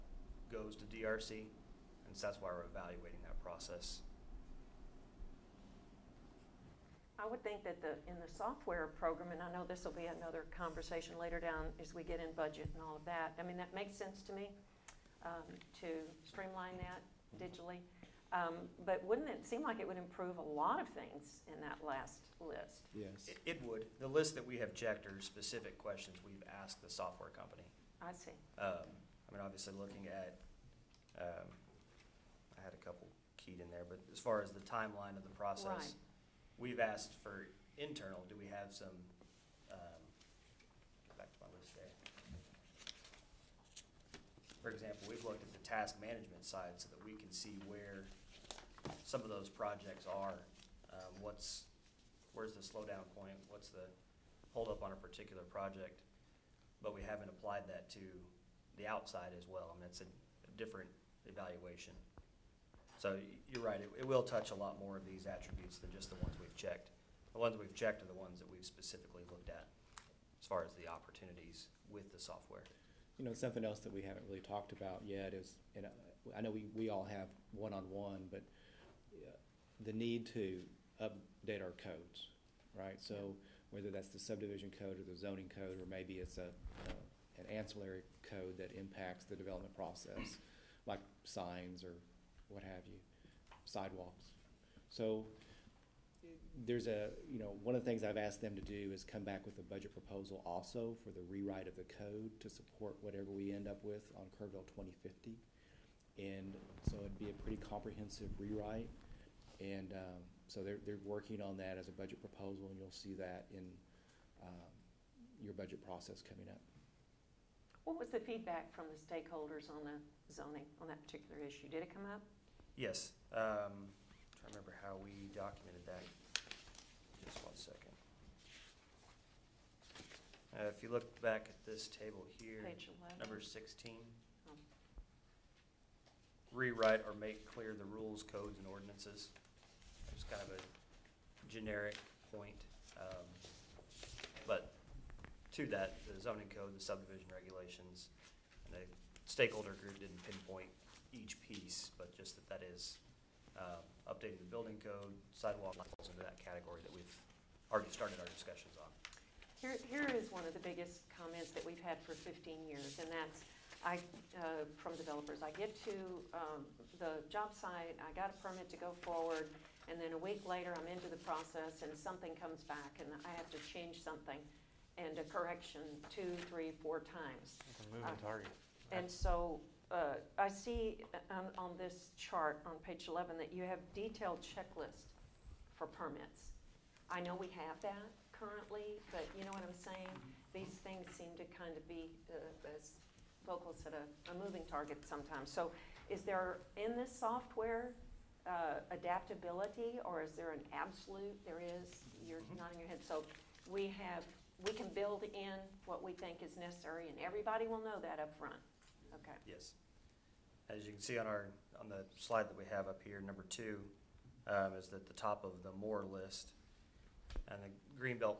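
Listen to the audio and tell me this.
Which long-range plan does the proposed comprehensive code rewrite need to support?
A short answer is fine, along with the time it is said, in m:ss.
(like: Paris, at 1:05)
Kerrville 2050, at 1:44.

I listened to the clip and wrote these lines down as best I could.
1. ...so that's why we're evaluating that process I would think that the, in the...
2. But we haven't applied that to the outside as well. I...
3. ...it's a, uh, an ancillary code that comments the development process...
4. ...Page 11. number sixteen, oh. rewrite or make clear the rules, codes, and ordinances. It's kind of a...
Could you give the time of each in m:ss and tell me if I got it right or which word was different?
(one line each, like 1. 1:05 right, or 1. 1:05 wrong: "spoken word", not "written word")
1. 0:02 right
2. 0:56 right
3. 1:26 wrong: "impacts", not "comments"
4. 2:12 right.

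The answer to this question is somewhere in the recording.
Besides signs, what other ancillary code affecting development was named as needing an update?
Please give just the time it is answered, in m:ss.
1:33.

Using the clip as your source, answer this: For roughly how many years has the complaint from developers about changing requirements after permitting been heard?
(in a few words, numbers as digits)
15 years.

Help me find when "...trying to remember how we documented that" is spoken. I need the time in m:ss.
2:04.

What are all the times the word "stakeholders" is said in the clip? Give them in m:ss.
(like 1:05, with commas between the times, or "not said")
1:58, 2:29.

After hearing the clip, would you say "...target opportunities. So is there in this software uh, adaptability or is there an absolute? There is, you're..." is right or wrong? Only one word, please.
wrong.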